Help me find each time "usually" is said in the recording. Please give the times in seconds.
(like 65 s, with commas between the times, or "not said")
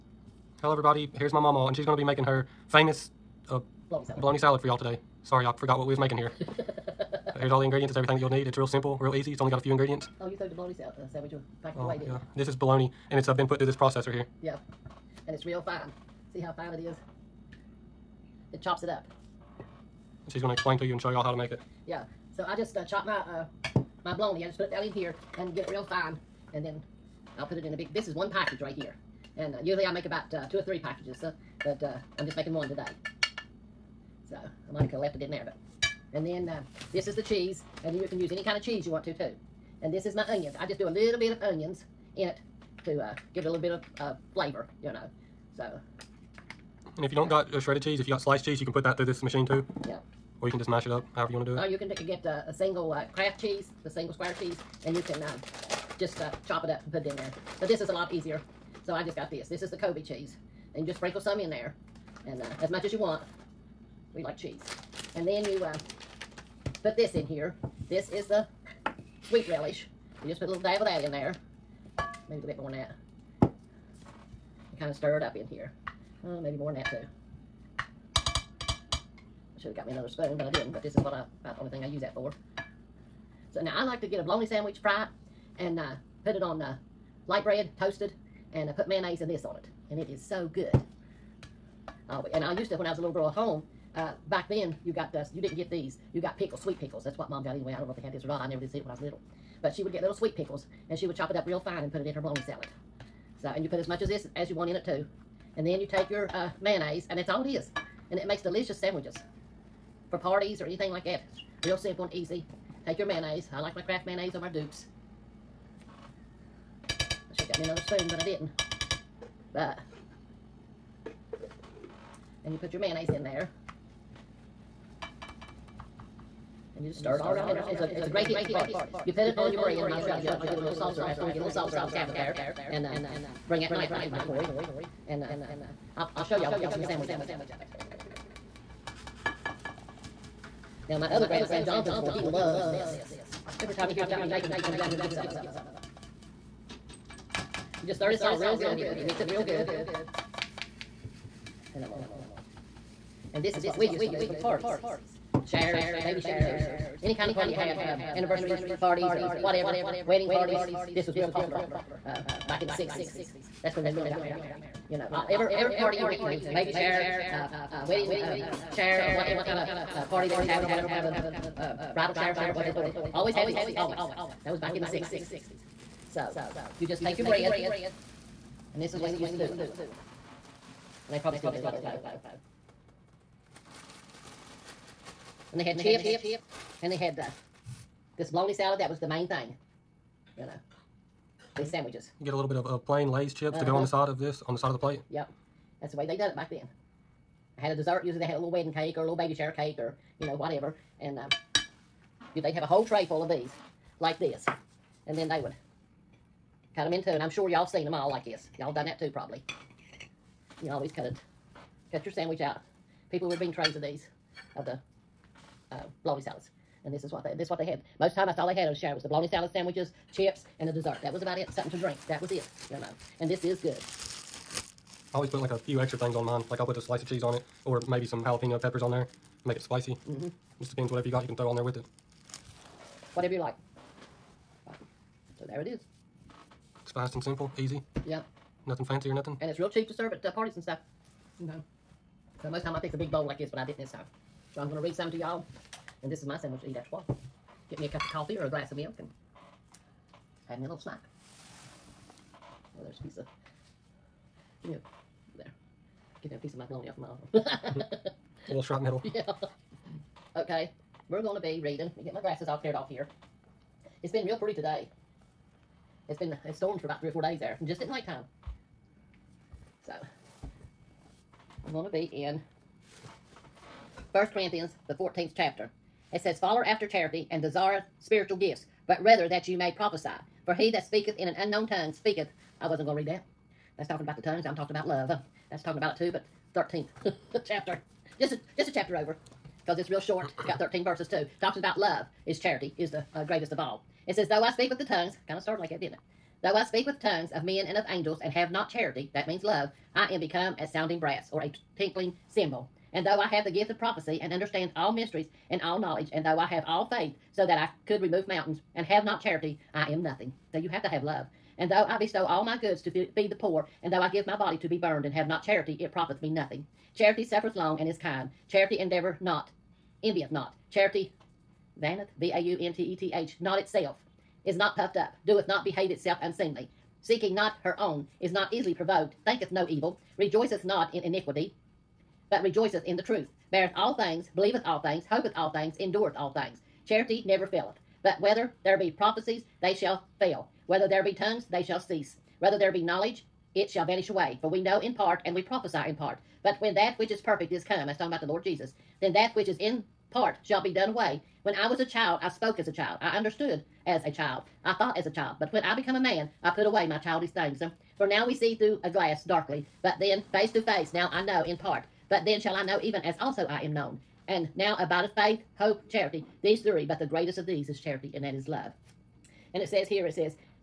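29 s, 198 s.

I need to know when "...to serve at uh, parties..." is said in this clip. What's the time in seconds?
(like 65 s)
239 s.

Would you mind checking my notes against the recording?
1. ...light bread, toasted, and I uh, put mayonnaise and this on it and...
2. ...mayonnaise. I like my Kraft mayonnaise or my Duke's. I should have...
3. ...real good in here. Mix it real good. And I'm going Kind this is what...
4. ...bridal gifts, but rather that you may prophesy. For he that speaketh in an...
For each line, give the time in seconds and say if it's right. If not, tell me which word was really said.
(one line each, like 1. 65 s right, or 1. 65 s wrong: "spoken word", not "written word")
1. 87 s right
2. 113 s right
3. 148 s wrong: "And", not "Kind"
4. 278 s wrong: "spiritual", not "bridal".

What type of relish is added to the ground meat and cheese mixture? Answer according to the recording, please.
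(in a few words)
sweet relish.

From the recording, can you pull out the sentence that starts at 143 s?
Every time he hears about me making it, he comes down here and gets some of it.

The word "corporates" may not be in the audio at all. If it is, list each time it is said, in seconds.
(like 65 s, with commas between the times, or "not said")
not said.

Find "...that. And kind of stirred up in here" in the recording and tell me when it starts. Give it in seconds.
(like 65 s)
72 s.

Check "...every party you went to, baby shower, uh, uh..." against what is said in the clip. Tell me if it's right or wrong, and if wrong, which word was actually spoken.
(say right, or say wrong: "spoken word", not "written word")
right.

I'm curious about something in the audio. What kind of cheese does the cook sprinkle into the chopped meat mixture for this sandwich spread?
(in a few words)
Colby.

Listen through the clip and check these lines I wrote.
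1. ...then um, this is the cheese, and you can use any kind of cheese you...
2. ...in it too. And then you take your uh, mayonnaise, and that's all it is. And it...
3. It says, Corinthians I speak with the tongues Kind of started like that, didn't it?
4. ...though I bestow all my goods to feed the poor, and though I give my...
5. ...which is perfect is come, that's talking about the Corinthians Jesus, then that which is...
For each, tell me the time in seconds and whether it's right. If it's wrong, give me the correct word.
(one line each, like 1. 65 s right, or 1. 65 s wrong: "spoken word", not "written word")
1. 36 s right
2. 104 s right
3. 294 s wrong: "Though", not "Corinthians"
4. 311 s right
5. 346 s wrong: "Lord", not "Corinthians".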